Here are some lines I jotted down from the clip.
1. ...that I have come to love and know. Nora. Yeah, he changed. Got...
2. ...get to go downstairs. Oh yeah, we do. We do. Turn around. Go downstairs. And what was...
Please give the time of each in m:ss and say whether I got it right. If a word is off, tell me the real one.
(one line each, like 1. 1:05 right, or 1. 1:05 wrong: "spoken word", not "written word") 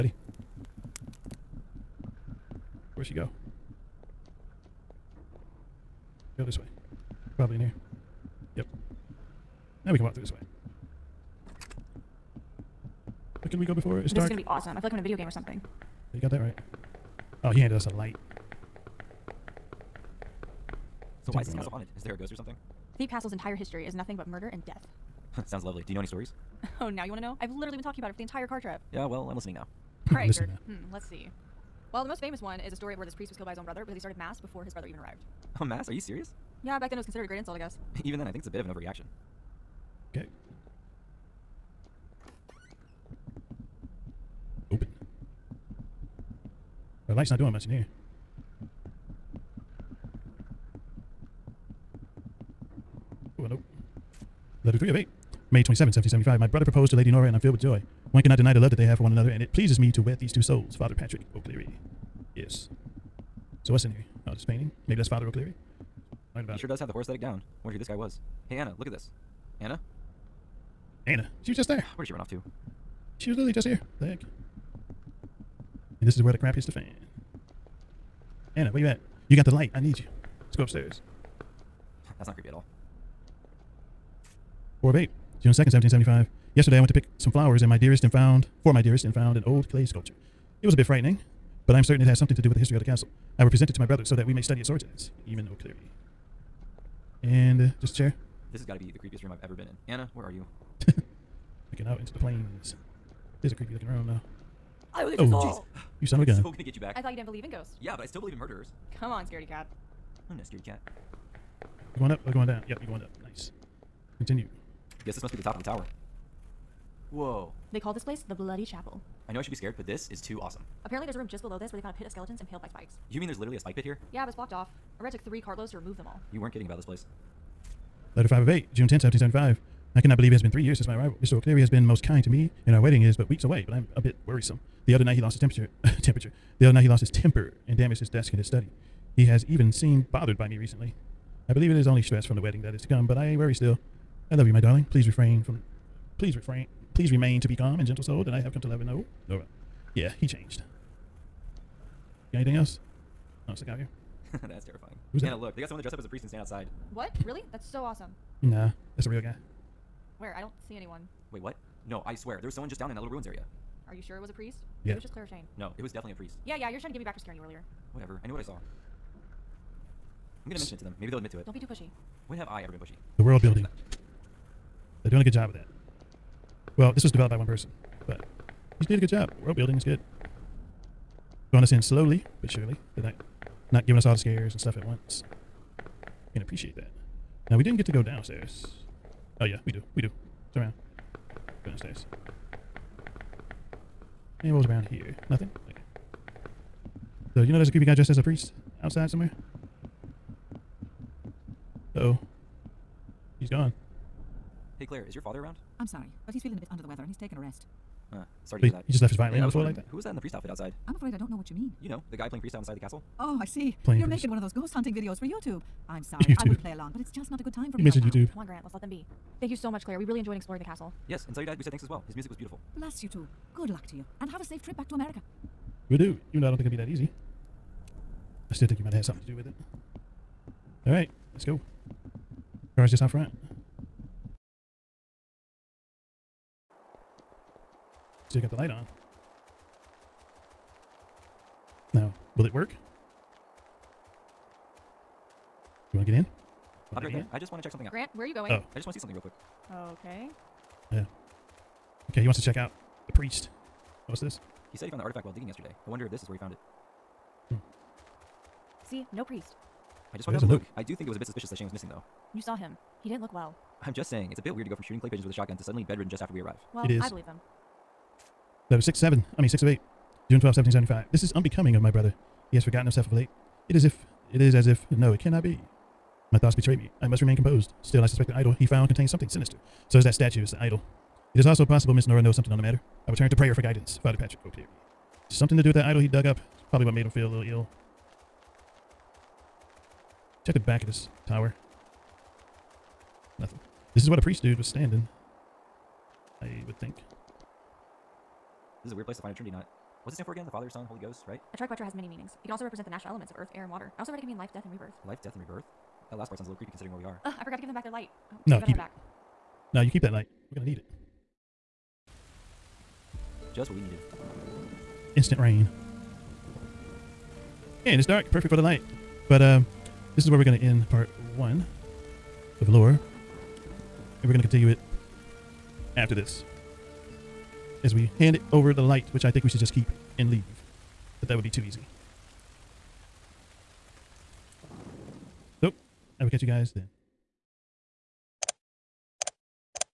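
1. 2:28 right
2. 3:07 right.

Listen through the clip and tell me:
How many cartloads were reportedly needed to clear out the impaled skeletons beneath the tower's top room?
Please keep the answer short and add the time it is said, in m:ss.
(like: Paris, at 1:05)
3, at 2:05.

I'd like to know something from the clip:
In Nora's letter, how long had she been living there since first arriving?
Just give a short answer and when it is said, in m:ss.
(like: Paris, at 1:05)
3 years, at 2:10.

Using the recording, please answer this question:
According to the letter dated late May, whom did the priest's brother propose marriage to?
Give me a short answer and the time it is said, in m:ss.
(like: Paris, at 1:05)
Lady Nora, at 0:56.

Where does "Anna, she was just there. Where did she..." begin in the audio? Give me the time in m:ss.
1:11.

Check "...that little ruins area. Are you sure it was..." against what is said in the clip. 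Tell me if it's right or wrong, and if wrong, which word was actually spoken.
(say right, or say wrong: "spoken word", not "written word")
right.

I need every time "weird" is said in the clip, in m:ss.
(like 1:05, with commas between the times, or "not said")
4:24, 4:58.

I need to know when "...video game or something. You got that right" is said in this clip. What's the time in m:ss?
0:15.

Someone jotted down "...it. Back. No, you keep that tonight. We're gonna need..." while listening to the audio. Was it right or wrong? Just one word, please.
wrong.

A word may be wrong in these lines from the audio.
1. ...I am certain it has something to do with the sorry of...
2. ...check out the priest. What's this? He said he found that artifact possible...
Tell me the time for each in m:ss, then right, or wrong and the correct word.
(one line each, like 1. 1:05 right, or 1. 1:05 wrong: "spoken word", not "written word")
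1. 1:31 wrong: "history", not "sorry"
2. 4:12 wrong: "while", not "possible".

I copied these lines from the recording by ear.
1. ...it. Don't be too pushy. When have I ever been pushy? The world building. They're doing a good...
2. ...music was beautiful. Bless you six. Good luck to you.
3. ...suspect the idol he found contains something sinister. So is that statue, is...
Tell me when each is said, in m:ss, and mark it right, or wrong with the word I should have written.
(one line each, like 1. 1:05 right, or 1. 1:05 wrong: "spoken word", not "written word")
1. 2:51 right
2. 3:42 wrong: "two", not "six"
3. 4:38 right.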